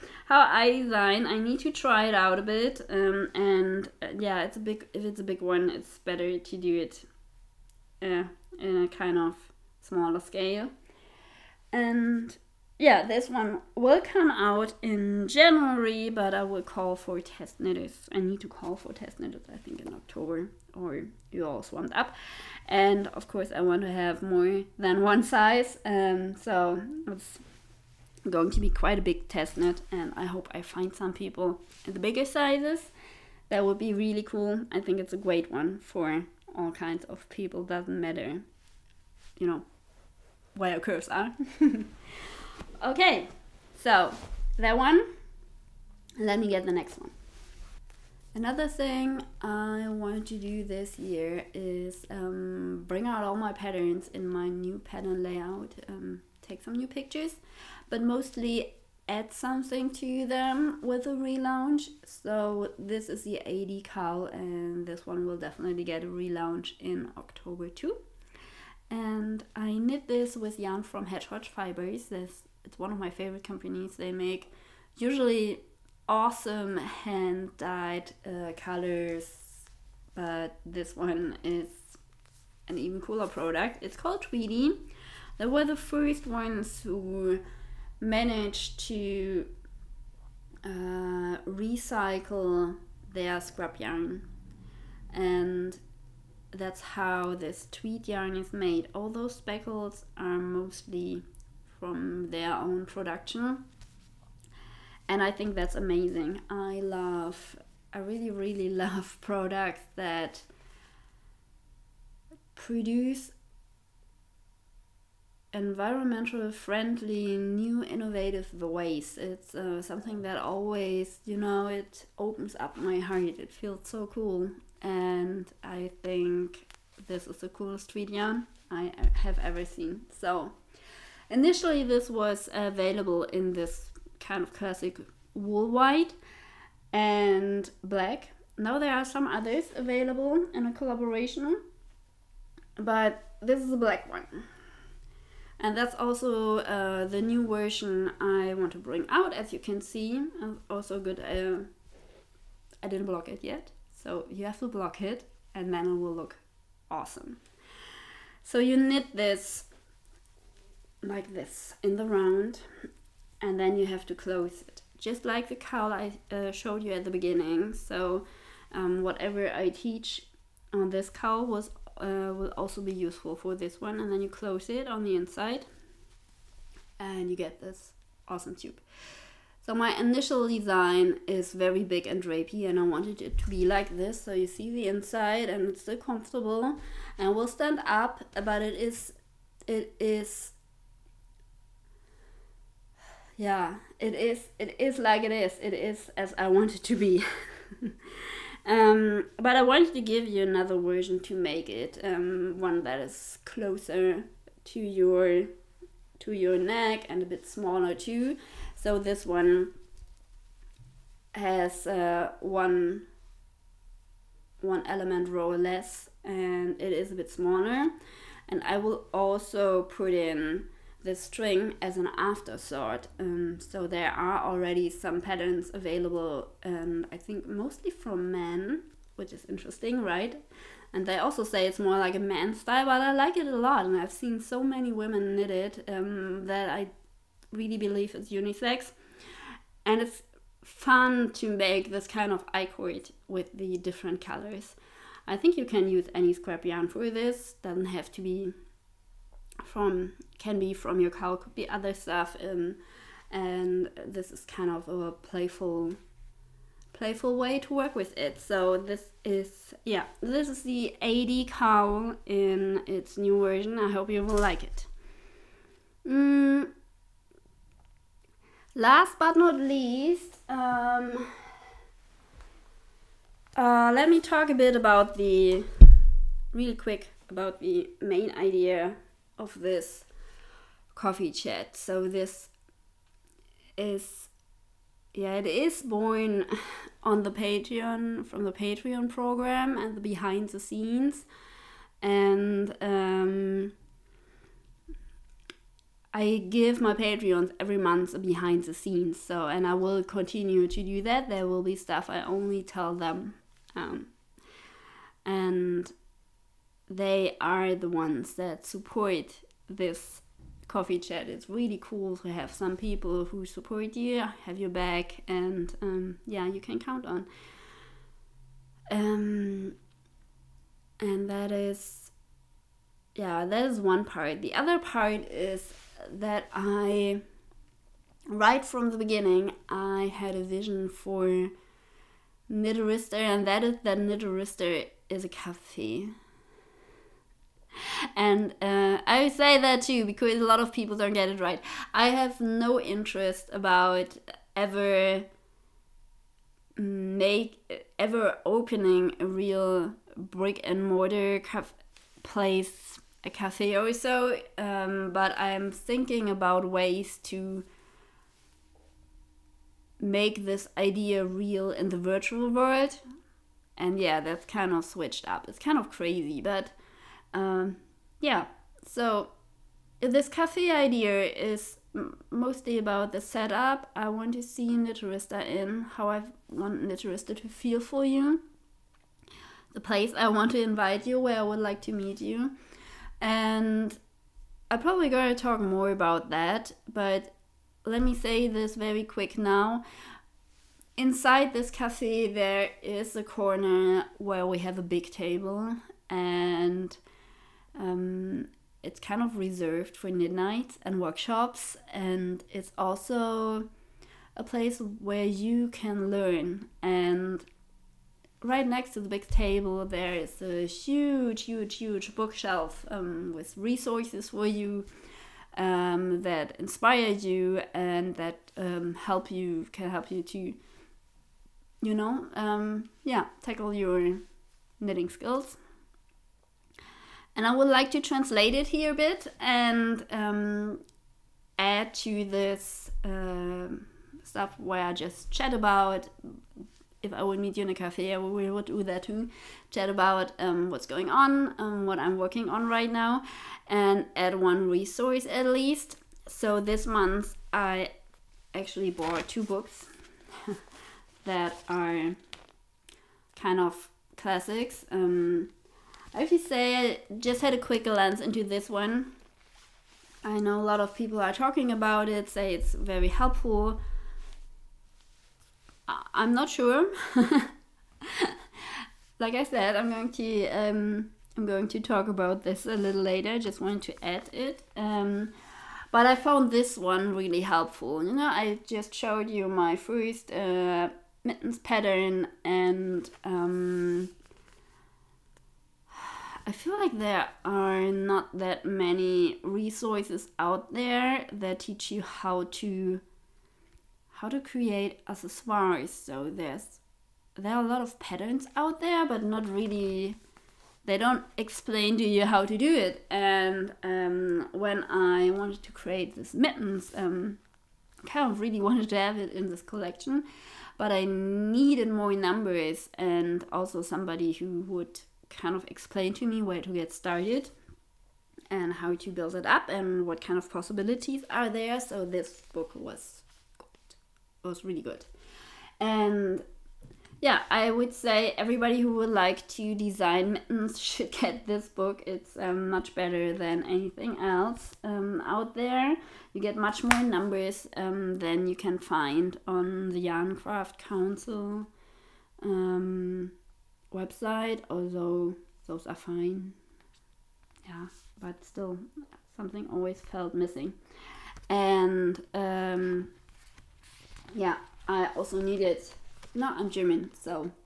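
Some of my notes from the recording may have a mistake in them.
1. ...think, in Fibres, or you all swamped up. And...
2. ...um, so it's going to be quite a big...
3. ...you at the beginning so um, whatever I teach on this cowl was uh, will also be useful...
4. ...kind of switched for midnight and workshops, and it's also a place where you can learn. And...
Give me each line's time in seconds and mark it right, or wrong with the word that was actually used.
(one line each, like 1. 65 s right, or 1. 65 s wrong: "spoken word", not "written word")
1. 19 s wrong: "October", not "Fibres"
2. 25 s right
3. 166 s right
4. 399 s wrong: "reserved", not "switched".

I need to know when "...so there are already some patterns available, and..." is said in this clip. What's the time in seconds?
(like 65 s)
223 s.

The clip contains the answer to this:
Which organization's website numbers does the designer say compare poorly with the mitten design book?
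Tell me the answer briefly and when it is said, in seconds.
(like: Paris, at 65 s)
Yarncraft Council, at 540 s.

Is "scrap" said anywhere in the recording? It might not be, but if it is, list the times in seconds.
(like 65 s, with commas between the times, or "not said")
93 s, 246 s.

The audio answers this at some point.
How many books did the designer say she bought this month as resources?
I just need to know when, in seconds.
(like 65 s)
449 s.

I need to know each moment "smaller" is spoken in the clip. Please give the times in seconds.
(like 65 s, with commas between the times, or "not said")
9 s, 207 s, 217 s.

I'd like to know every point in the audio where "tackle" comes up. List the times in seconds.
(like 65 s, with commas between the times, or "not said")
423 s.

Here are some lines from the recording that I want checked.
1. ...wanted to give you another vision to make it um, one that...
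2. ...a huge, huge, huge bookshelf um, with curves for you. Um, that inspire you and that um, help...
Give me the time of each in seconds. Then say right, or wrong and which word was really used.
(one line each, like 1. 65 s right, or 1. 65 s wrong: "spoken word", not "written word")
1. 199 s wrong: "version", not "vision"
2. 410 s wrong: "resources", not "curves".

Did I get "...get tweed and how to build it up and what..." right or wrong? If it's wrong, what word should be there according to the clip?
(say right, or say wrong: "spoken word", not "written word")
wrong: "started", not "tweed".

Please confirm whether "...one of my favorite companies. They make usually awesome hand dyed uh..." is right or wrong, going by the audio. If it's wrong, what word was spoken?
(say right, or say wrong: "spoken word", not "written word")
right.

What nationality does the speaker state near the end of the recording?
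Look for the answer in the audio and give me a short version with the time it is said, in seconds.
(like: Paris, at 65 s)
German, at 556 s.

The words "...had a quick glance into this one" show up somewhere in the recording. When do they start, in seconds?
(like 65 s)
457 s.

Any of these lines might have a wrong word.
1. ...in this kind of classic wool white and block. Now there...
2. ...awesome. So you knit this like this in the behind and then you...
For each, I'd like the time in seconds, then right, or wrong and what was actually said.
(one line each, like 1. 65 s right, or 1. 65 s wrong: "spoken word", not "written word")
1. 133 s wrong: "black", not "block"
2. 156 s wrong: "round", not "behind".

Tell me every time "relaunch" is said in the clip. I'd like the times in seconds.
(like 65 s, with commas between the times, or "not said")
61 s, 66 s.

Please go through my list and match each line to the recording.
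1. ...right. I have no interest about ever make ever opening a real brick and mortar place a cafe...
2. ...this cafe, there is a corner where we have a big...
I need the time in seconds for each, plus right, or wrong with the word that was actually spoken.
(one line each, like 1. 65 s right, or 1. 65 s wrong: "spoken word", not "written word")
1. 341 s right
2. 391 s right.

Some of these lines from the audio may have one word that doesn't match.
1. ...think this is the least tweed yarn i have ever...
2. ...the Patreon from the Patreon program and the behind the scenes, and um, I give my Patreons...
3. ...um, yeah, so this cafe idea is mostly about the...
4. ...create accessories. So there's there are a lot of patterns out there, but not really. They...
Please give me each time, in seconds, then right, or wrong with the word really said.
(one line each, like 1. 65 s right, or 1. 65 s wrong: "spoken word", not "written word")
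1. 126 s wrong: "coolest", not "least"
2. 287 s right
3. 367 s right
4. 494 s right.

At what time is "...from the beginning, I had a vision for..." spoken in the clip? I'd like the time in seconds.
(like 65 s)
328 s.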